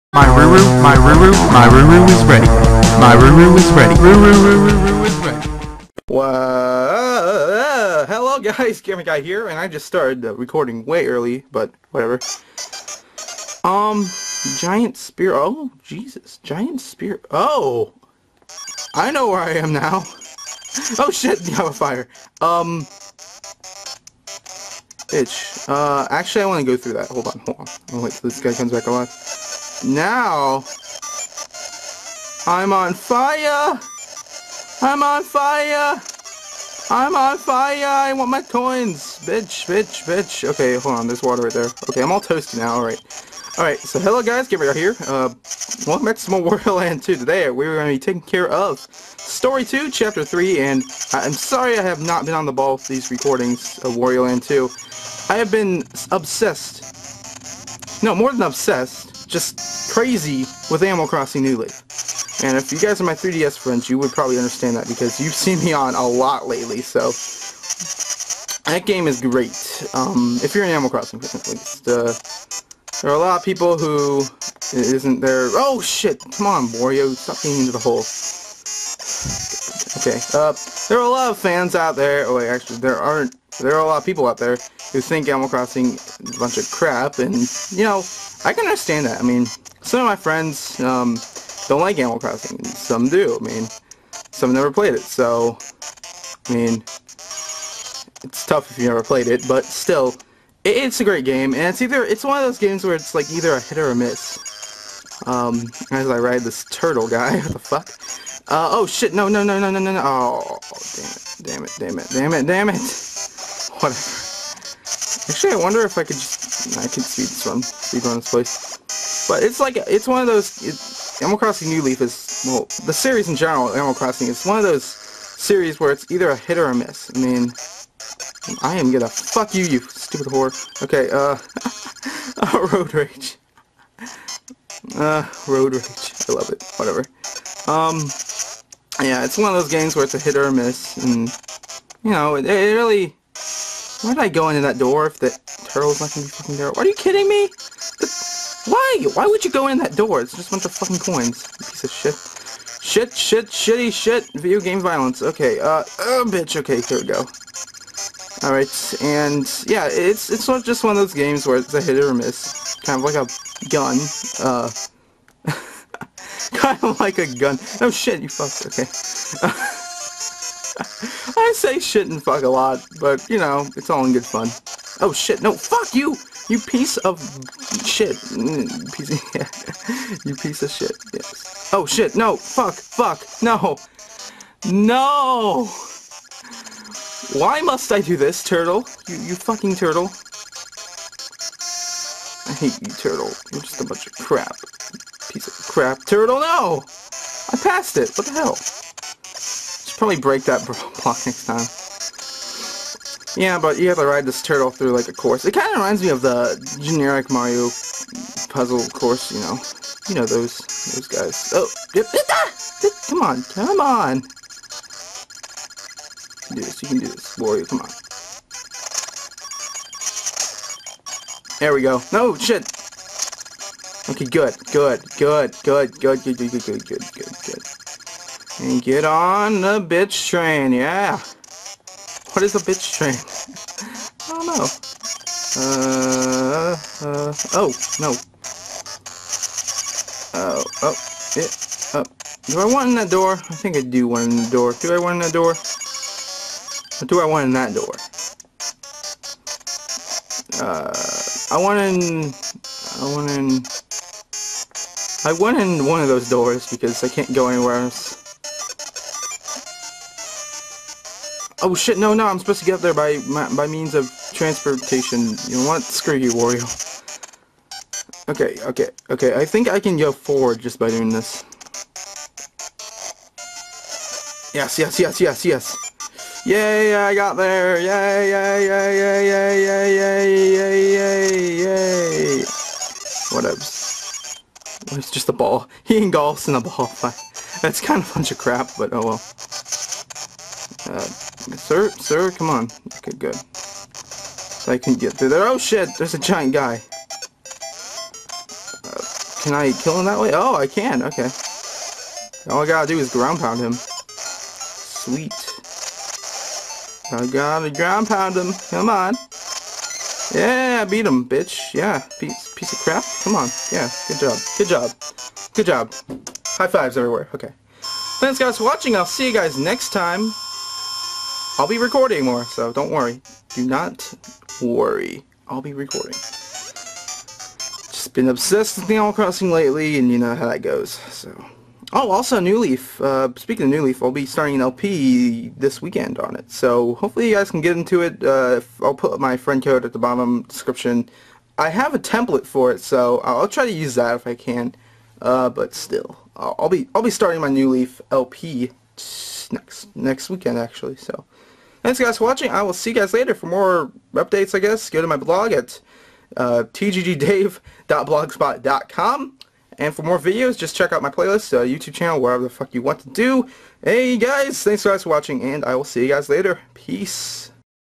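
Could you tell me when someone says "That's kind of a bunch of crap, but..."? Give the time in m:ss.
4:47.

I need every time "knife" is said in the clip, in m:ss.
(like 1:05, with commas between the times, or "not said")
not said.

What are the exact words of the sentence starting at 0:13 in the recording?
Um, Giant Spear, oh, Jesus, Giant Spear, oh!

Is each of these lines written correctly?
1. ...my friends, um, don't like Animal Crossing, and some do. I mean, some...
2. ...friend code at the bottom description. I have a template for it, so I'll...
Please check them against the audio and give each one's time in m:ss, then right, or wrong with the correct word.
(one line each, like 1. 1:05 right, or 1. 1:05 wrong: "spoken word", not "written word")
1. 1:30 right
2. 5:39 right.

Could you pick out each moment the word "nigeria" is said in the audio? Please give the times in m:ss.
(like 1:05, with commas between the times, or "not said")
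not said.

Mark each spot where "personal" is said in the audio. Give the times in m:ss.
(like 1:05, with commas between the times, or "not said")
not said.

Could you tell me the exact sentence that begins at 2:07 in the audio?
I mean, I am gonna fuck you, you stupid whore.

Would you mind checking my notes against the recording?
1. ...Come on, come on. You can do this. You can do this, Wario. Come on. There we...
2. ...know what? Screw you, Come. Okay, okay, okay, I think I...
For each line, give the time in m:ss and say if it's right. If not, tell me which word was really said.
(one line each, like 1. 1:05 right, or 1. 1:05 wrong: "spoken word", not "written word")
1. 3:33 right
2. 4:25 wrong: "Wario", not "Come".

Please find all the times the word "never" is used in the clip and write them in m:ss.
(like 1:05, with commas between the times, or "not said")
1:34, 1:38.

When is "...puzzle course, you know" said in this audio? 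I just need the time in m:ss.
3:28.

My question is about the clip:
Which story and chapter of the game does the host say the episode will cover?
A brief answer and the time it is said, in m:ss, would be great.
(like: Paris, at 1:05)
Story 2, Chapter 3, at 0:48.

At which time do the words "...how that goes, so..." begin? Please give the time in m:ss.
5:30.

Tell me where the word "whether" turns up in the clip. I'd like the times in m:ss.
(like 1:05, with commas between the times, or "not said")
not said.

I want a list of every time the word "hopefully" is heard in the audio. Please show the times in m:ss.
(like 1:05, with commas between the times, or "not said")
5:36.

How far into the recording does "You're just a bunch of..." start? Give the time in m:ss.
3:13.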